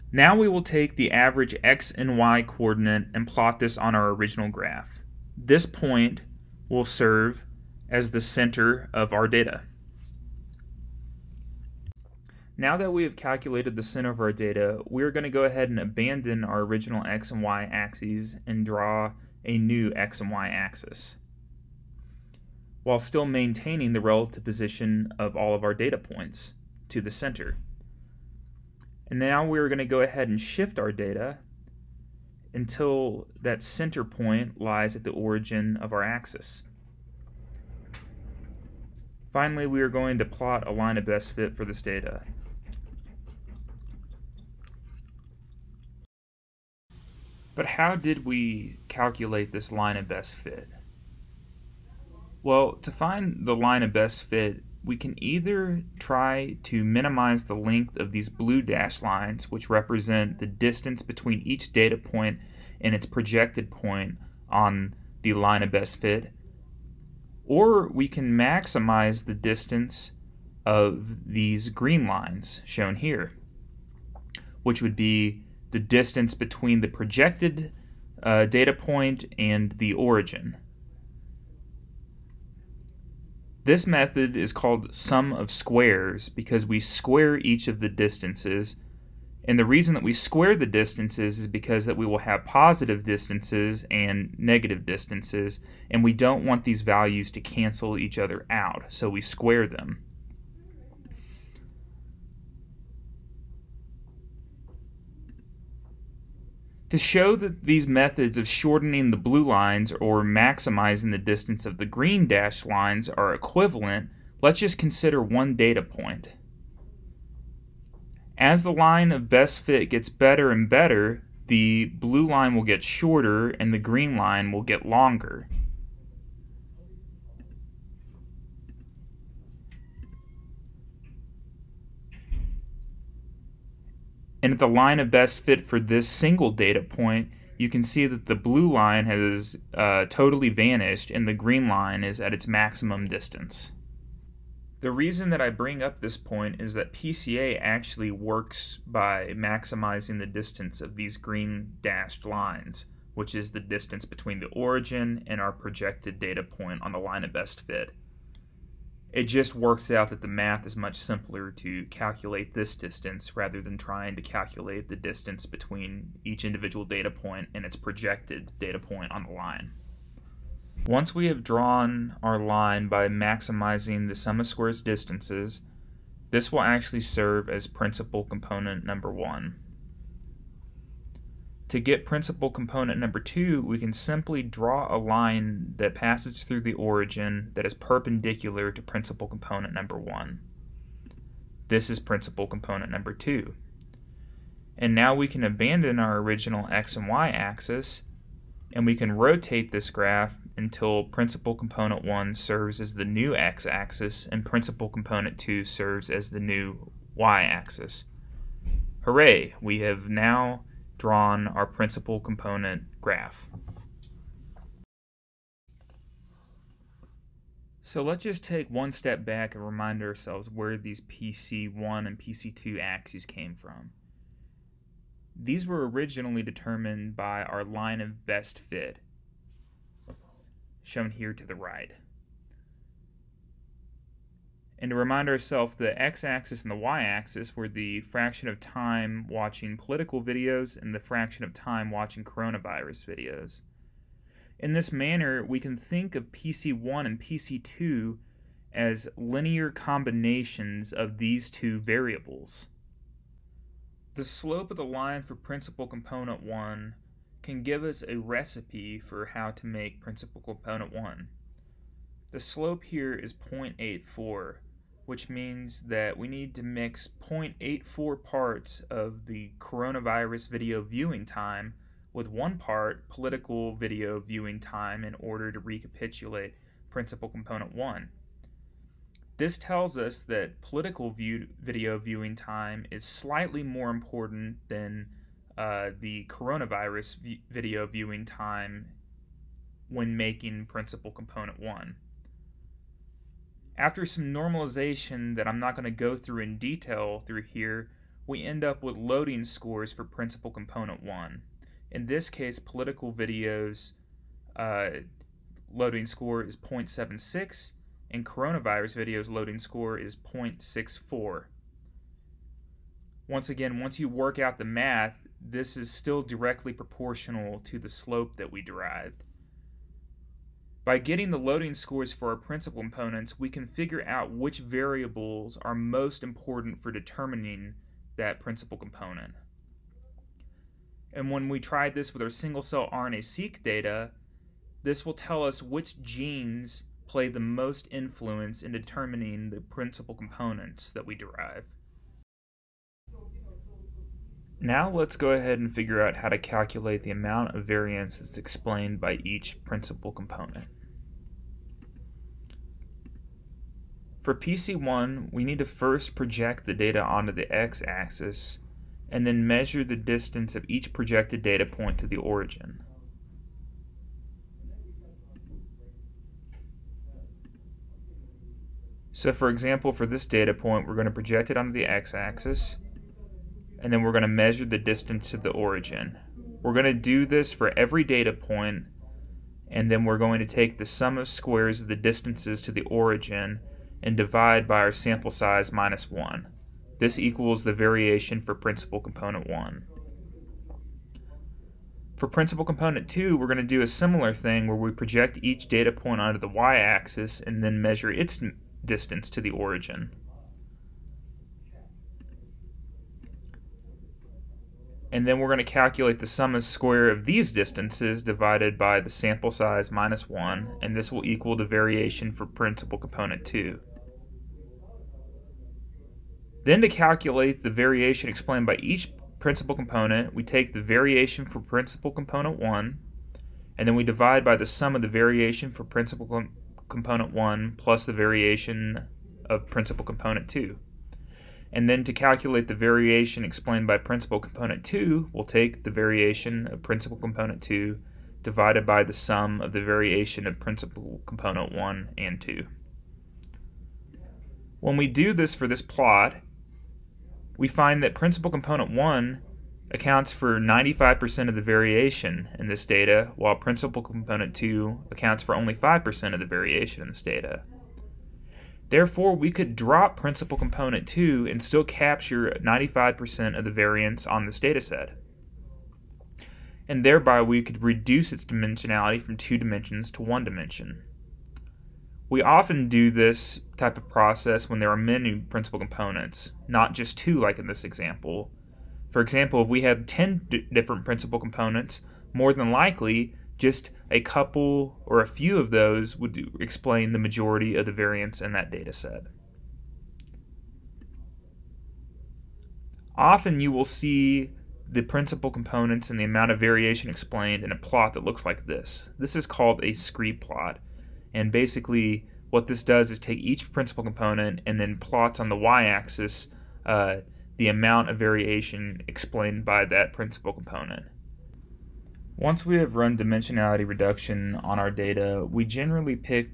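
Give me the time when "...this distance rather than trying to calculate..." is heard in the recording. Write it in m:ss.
2:42.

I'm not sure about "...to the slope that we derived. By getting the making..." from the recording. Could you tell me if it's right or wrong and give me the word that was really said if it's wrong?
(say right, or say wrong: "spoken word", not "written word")
wrong: "loading", not "making".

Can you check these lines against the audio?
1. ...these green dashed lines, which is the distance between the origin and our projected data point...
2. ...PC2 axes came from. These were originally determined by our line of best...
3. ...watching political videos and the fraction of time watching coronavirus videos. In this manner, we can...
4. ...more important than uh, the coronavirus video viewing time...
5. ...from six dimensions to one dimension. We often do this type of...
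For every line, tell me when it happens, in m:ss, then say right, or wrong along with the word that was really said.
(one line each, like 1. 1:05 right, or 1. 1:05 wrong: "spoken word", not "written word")
1. 2:30 right
2. 3:42 right
3. 3:59 right
4. 4:43 right
5. 7:49 wrong: "two", not "six".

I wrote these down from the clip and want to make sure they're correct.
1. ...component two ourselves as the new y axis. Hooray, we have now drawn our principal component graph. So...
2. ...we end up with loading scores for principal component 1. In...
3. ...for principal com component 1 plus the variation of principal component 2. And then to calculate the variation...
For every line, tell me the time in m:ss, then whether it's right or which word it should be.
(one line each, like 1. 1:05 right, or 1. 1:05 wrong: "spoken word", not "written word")
1. 3:24 wrong: "serves", not "ourselves"
2. 4:58 right
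3. 7:05 right.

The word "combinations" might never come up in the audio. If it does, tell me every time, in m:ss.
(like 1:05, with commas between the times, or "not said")
4:09.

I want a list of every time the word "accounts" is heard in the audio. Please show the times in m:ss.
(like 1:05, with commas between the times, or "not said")
7:29, 7:35.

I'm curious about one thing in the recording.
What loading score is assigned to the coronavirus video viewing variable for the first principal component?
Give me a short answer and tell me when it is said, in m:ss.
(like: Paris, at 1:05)
0.64, at 5:10.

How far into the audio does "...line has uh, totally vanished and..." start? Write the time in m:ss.
2:18.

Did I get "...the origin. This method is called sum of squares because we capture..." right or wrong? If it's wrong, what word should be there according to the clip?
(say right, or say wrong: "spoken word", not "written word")
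wrong: "square", not "capture".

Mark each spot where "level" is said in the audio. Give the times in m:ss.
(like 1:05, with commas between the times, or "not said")
not said.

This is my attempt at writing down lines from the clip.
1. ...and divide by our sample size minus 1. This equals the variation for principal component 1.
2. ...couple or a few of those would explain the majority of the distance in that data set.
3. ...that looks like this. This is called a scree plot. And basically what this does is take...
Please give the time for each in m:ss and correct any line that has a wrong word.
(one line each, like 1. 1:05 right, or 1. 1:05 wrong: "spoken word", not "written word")
1. 6:24 right
2. 8:04 wrong: "variance", not "distance"
3. 8:18 right.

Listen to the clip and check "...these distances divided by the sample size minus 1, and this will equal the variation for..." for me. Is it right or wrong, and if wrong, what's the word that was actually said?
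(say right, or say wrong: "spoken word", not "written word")
right.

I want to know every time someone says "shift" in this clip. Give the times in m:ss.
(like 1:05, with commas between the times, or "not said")
0:30.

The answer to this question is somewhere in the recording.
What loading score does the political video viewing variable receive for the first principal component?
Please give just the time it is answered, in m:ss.
5:06.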